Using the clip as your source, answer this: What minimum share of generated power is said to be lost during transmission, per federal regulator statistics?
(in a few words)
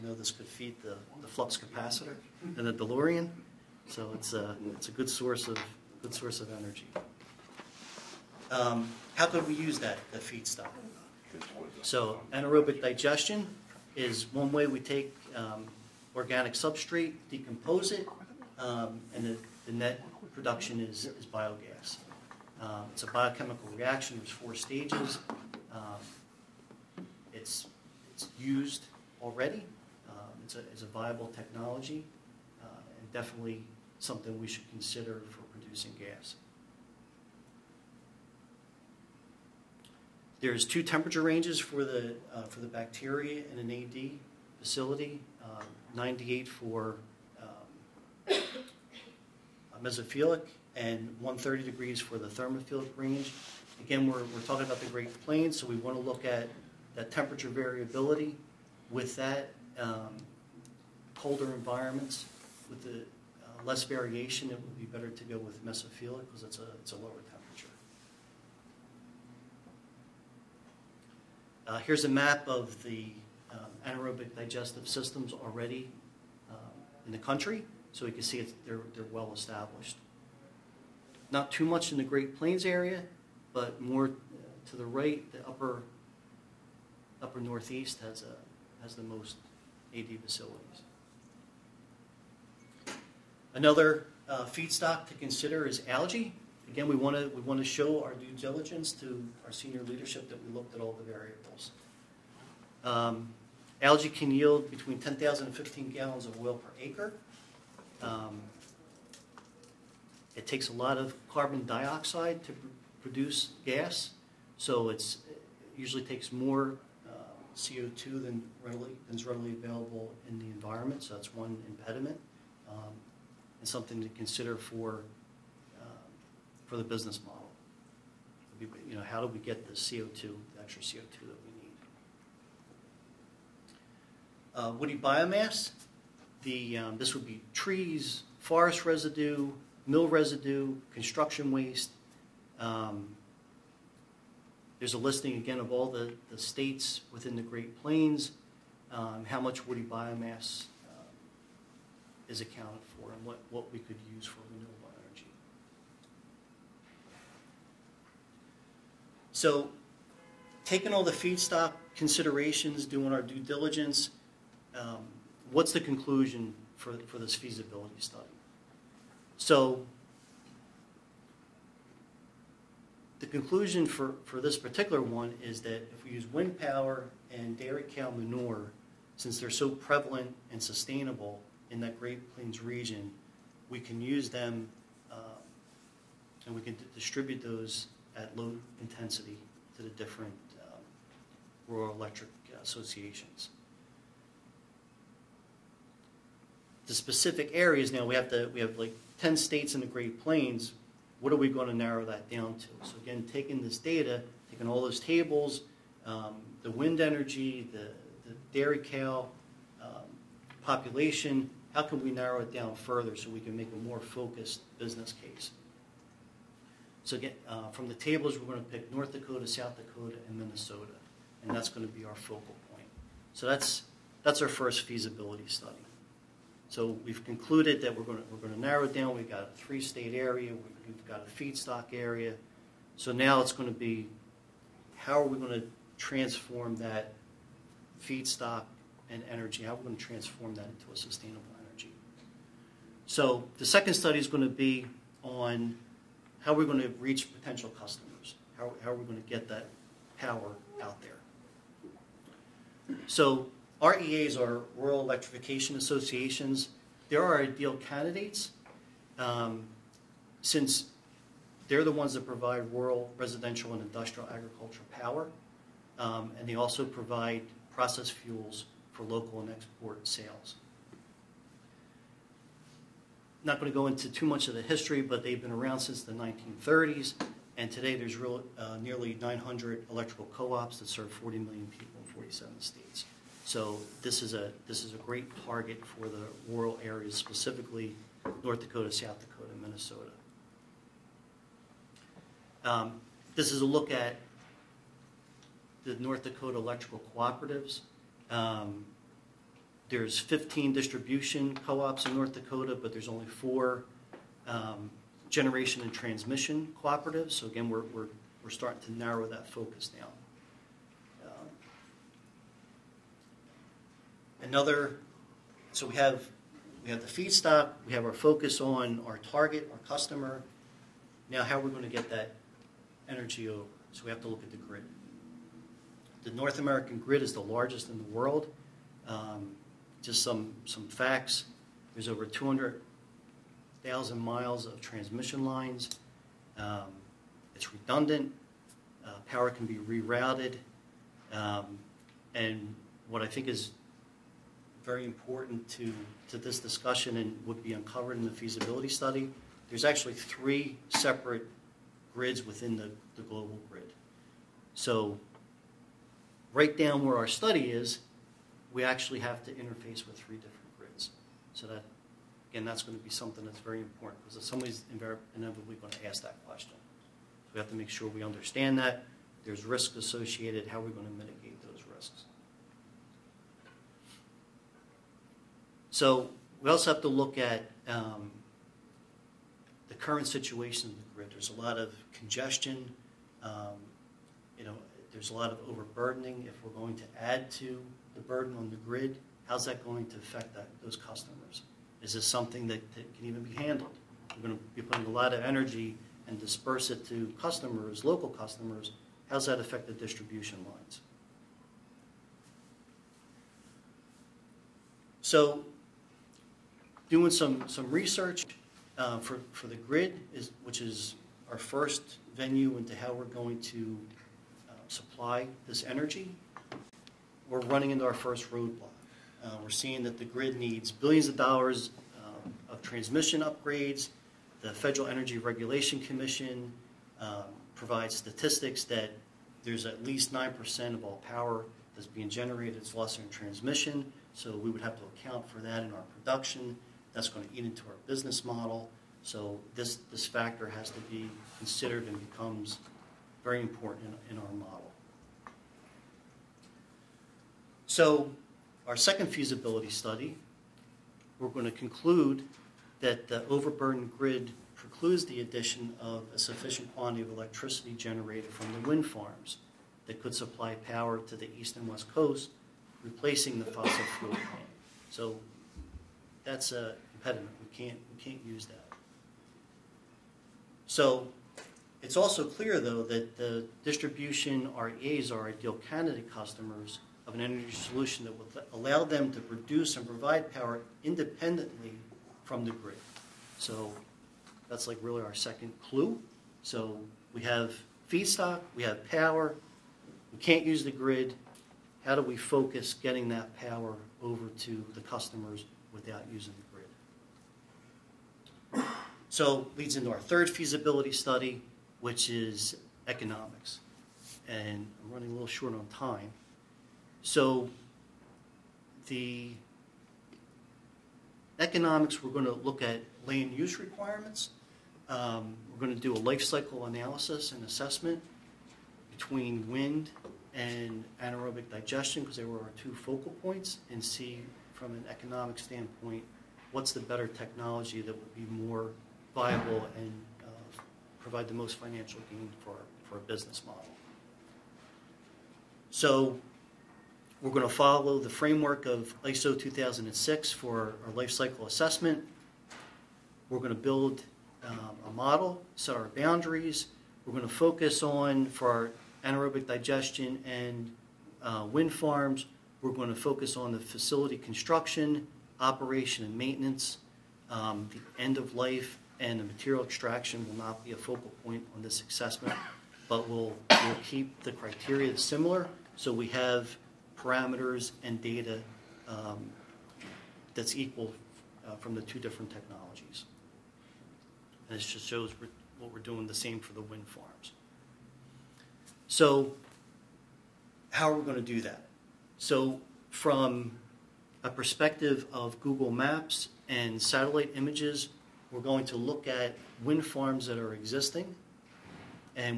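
9%.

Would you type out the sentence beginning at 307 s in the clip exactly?
So again, we're, we're, we're starting to narrow that focus down.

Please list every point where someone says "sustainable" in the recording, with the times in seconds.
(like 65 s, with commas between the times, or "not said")
180 s, 240 s.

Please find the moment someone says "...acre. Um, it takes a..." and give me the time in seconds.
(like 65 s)
106 s.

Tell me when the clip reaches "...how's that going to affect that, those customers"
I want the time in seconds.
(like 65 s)
389 s.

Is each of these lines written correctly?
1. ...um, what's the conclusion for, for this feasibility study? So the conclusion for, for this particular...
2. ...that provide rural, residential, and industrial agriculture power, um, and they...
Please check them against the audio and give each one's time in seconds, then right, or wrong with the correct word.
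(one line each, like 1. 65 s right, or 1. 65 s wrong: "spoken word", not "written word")
1. 164 s right
2. 262 s right.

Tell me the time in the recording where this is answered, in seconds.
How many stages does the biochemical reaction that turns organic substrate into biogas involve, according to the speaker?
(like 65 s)
24 s.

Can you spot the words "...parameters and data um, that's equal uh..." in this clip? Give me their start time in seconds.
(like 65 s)
567 s.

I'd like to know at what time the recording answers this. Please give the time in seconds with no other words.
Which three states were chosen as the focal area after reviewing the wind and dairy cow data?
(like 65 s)
218 s.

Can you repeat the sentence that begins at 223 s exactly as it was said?
So that's that's our first feasibility study.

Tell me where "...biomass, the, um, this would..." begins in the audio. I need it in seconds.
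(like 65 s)
134 s.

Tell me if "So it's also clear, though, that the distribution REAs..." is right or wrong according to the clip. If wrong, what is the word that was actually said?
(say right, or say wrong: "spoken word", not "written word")
right.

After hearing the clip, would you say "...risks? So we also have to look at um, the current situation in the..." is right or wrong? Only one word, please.
right.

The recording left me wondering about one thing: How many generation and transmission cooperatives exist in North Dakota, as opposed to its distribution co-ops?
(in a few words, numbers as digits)
4.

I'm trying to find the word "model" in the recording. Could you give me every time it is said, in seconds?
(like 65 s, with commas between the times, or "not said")
127 s, 438 s, 444 s, 533 s, 545 s.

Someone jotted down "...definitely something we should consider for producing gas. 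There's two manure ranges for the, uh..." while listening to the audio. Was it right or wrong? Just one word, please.
wrong.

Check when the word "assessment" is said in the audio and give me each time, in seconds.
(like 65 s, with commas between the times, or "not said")
517 s, 541 s, 562 s.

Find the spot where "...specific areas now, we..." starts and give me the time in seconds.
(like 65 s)
196 s.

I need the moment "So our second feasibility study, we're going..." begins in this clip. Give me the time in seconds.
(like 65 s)
447 s.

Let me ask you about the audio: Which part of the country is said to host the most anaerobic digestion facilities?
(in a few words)
upper northeast.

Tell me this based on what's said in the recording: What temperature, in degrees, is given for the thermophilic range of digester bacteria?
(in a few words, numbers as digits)
130.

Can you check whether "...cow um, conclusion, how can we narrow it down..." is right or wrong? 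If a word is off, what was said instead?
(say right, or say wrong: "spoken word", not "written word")
wrong: "population", not "conclusion".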